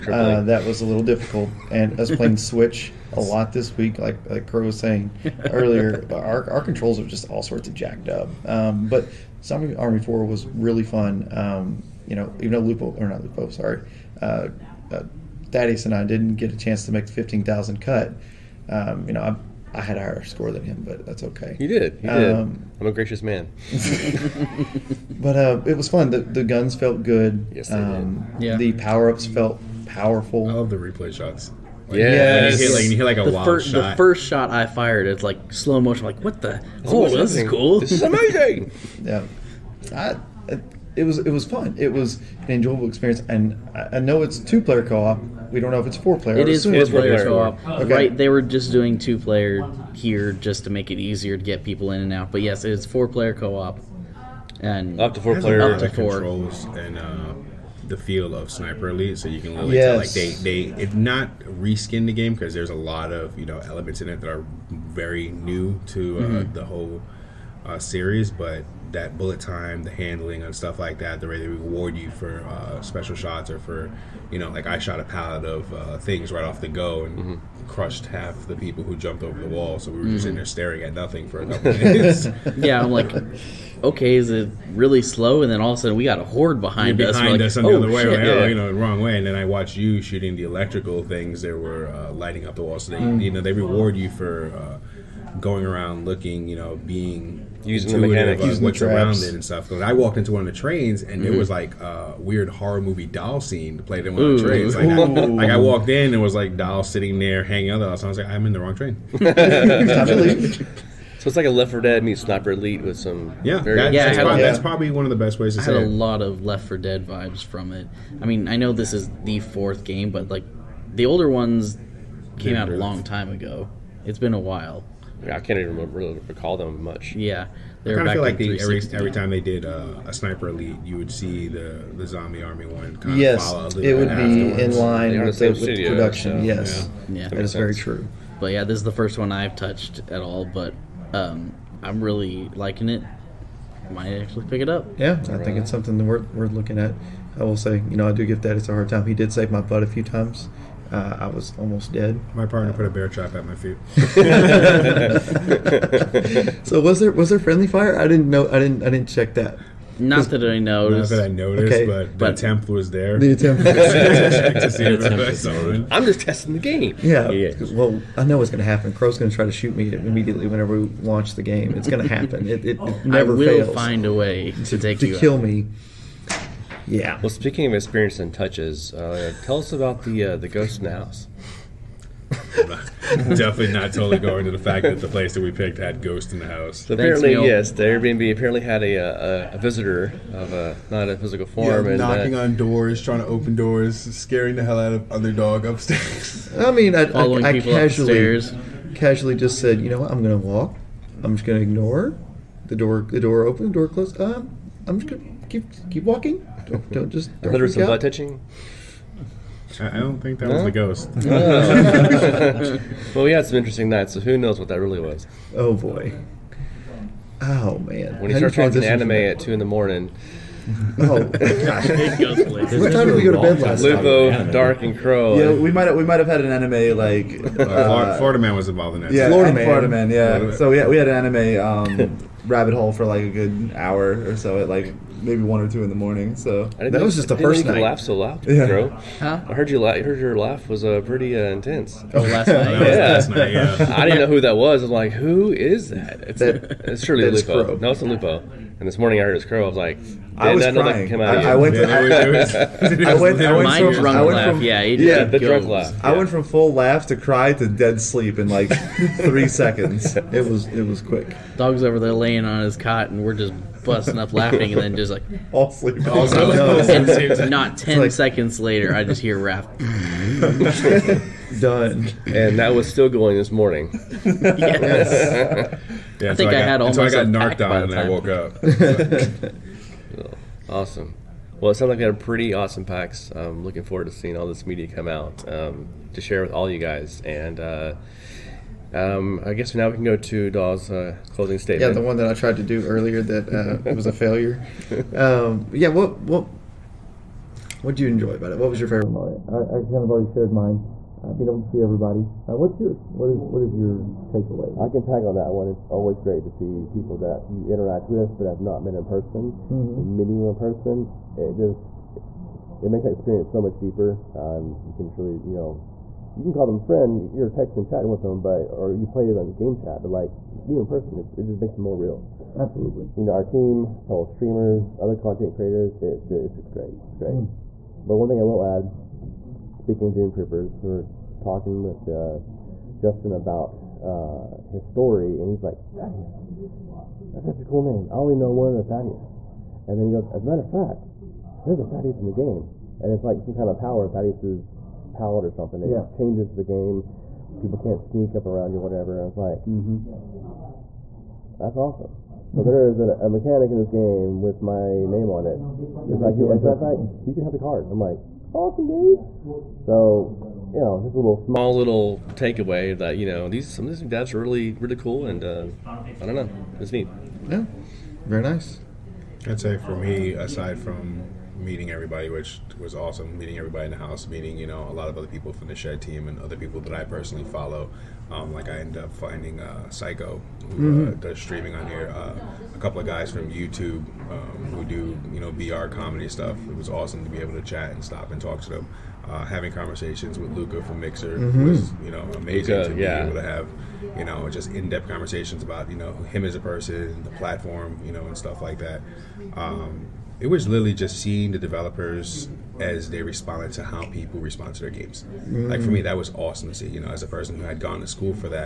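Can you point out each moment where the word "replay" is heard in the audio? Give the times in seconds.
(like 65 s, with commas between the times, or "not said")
30 s.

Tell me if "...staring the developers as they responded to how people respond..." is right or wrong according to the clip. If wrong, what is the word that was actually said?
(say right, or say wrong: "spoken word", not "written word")
wrong: "seeing", not "staring".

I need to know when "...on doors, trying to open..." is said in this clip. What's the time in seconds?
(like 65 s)
192 s.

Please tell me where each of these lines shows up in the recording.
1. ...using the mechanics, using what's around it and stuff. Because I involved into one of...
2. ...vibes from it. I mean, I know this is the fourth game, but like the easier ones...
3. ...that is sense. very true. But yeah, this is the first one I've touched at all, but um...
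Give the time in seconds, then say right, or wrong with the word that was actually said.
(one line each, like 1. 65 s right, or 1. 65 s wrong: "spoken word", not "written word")
1. 97 s wrong: "walked", not "involved"
2. 117 s wrong: "older", not "easier"
3. 137 s right.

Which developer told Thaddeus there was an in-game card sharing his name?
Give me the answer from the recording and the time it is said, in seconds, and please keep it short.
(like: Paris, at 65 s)
Justin, at 332 s.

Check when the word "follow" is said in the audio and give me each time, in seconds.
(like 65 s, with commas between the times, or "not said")
133 s, 377 s.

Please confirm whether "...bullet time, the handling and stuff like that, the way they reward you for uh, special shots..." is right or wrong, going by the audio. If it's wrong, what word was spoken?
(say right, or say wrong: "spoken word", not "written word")
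right.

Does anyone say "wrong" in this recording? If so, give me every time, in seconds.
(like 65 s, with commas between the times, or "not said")
88 s, 108 s.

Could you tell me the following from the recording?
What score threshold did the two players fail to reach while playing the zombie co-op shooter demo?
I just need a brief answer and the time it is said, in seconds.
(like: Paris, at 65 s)
15,000, at 17 s.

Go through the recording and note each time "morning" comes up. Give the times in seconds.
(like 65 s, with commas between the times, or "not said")
219 s, 235 s, 248 s, 273 s.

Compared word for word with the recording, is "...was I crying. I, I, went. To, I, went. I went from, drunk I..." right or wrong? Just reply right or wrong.
right.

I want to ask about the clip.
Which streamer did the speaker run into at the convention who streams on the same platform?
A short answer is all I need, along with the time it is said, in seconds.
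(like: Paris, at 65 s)
Psycho, at 379 s.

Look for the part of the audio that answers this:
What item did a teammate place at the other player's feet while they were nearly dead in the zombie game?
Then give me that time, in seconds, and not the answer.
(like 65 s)
152 s.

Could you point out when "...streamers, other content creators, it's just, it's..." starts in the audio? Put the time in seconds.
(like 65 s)
324 s.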